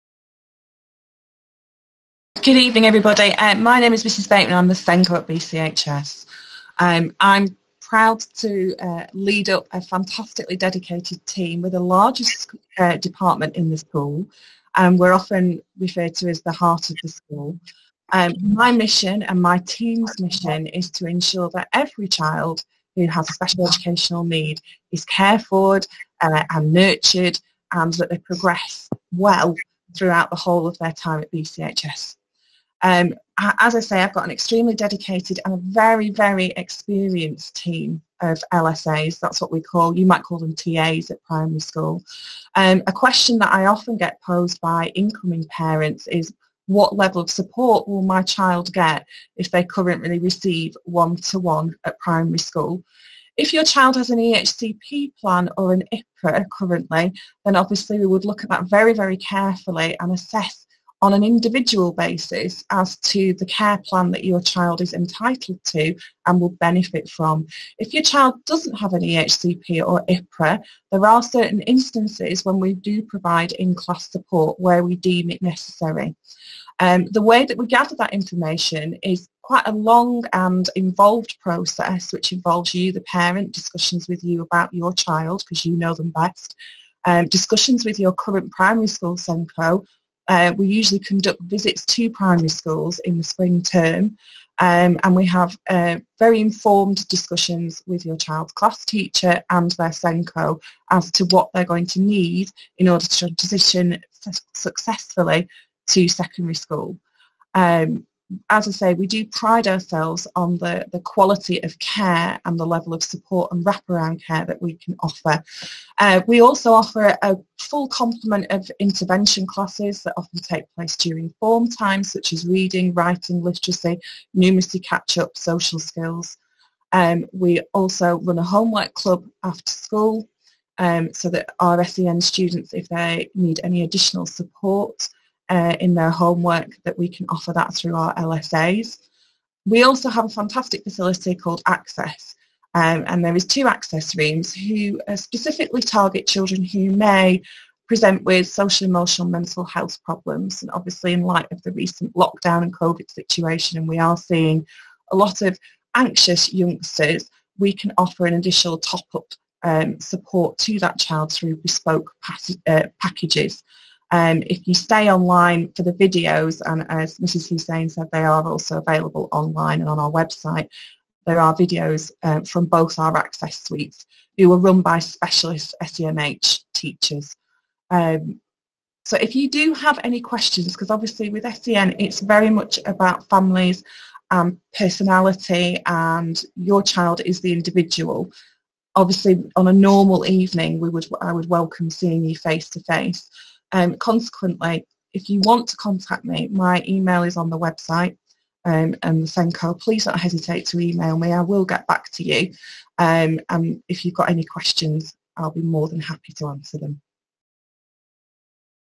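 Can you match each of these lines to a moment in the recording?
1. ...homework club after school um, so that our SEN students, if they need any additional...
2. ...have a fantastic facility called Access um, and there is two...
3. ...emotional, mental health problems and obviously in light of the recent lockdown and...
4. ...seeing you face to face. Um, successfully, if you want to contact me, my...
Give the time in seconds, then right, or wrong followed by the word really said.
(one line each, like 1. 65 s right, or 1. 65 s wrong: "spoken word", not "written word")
1. 128 s right
2. 140 s right
3. 148 s right
4. 191 s wrong: "consequently", not "successfully".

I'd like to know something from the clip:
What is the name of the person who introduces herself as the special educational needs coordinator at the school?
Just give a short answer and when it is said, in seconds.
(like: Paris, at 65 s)
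Mrs. Bateman, at 4 s.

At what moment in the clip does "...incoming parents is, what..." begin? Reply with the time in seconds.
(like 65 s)
44 s.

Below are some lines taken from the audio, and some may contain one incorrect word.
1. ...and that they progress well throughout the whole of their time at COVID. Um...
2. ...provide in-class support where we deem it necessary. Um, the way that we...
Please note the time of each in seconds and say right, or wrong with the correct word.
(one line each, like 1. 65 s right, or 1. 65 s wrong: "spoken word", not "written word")
1. 27 s wrong: "BCHS", not "COVID"
2. 73 s right.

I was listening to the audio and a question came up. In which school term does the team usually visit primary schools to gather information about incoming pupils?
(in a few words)
spring term.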